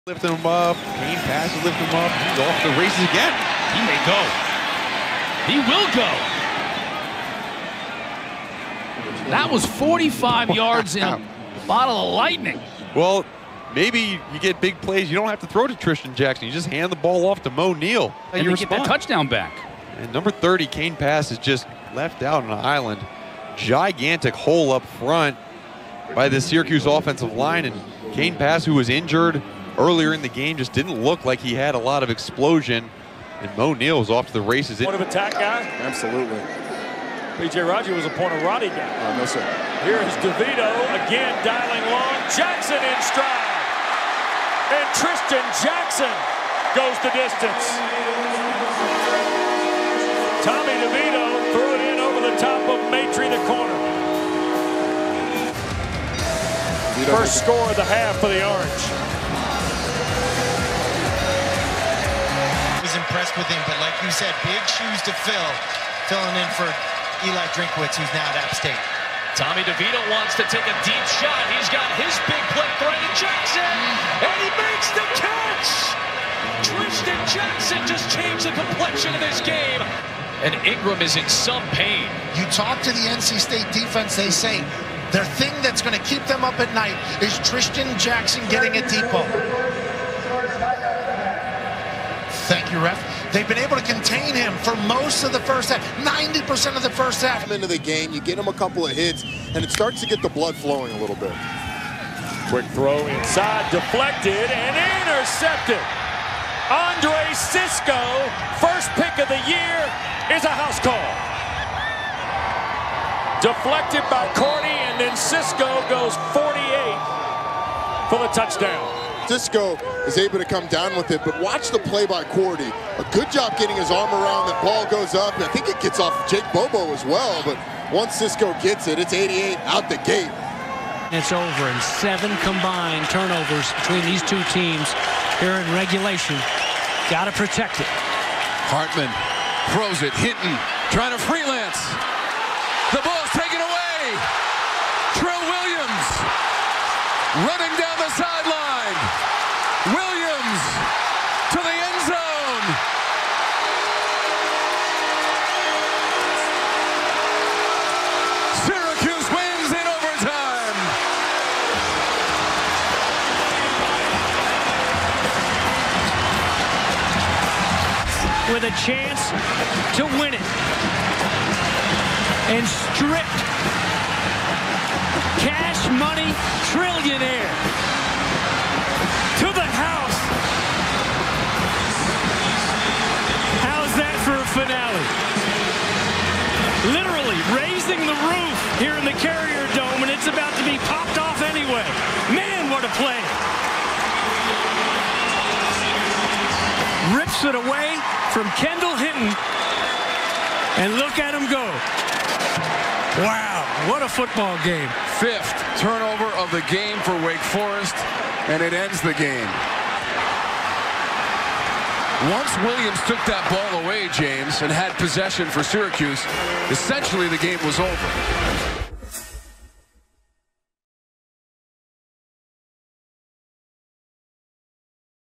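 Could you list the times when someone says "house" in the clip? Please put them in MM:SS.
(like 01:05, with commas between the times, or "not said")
01:50, 02:59.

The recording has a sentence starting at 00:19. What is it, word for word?
And number 30, Kane Pass, is just left out on an island.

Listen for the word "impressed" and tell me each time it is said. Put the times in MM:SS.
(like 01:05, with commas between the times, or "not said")
01:03.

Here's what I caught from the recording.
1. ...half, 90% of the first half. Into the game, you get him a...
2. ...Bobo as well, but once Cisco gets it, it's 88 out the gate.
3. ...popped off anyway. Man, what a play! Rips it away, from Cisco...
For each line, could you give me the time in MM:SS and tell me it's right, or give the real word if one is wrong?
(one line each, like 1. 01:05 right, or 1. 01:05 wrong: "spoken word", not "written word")
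1. 01:35 right
2. 02:06 right
3. 03:10 wrong: "Kendall", not "Cisco".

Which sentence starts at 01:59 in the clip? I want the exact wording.
Cisco is able to come down with it, but watch the play by Cordy.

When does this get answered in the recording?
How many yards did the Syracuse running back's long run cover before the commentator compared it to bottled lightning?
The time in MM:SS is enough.
00:09.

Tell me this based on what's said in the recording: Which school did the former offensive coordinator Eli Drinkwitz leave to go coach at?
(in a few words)
App State.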